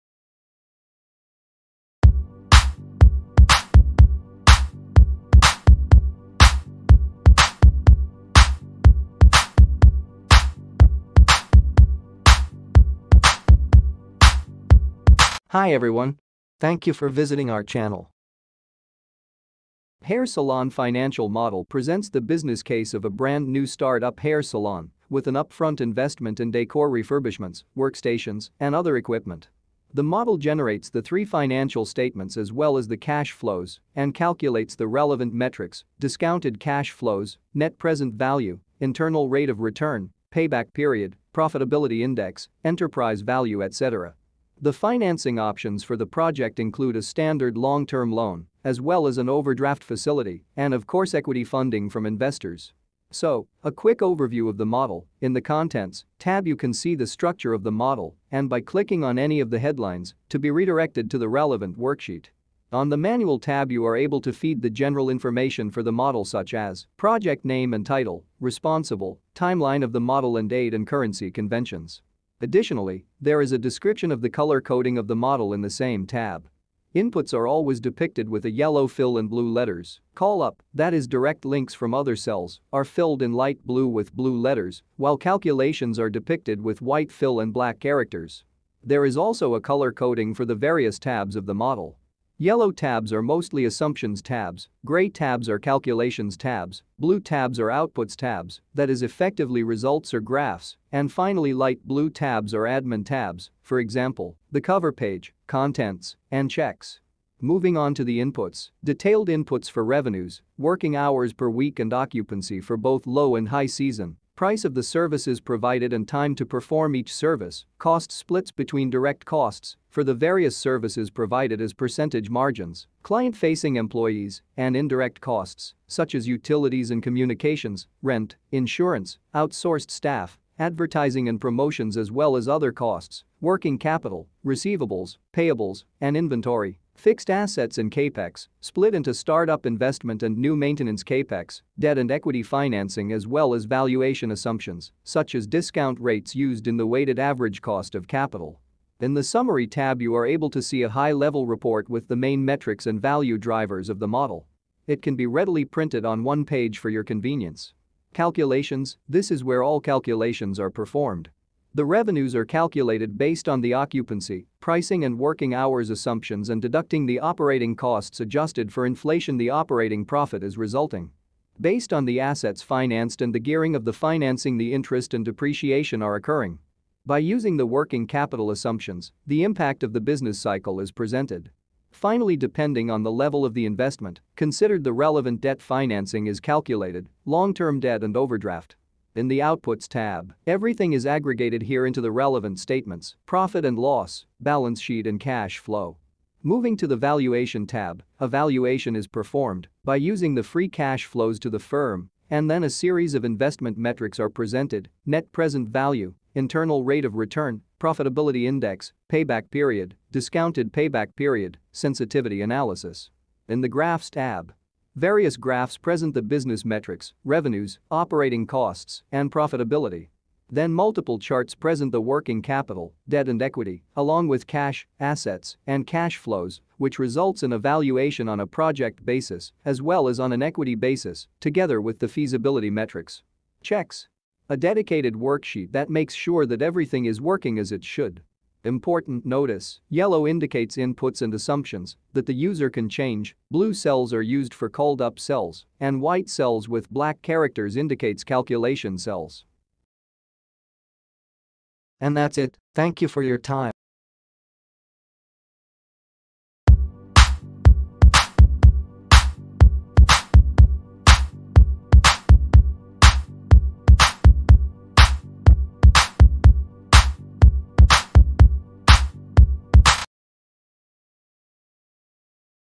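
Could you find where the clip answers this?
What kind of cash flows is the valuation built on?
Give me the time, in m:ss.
3:20.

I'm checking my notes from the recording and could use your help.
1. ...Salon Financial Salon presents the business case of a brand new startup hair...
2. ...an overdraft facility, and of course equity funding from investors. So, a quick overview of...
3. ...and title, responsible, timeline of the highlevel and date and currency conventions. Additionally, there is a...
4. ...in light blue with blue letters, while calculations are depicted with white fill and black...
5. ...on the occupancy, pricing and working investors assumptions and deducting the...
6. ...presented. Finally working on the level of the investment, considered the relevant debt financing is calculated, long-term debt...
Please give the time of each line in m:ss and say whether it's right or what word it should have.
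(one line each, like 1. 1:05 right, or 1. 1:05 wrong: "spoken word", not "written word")
1. 0:20 wrong: "Model", not "Salon"
2. 0:49 right
3. 1:07 wrong: "model", not "highlevel"
4. 1:23 right
5. 2:43 wrong: "hours", not "investors"
6. 3:00 wrong: "depending", not "working".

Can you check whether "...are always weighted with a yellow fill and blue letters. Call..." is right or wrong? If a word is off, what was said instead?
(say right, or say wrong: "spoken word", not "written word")
wrong: "depicted", not "weighted".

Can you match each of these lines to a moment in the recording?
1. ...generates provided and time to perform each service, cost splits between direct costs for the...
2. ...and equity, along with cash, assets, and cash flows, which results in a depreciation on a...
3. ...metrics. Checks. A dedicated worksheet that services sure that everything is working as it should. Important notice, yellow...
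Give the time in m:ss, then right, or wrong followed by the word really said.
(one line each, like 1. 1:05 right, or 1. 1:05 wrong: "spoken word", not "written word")
1. 1:54 wrong: "services", not "generates"
2. 3:43 wrong: "valuation", not "depreciation"
3. 3:52 wrong: "makes", not "services".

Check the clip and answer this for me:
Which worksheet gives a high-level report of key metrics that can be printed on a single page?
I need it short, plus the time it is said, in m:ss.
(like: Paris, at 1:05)
Summary tab, at 2:29.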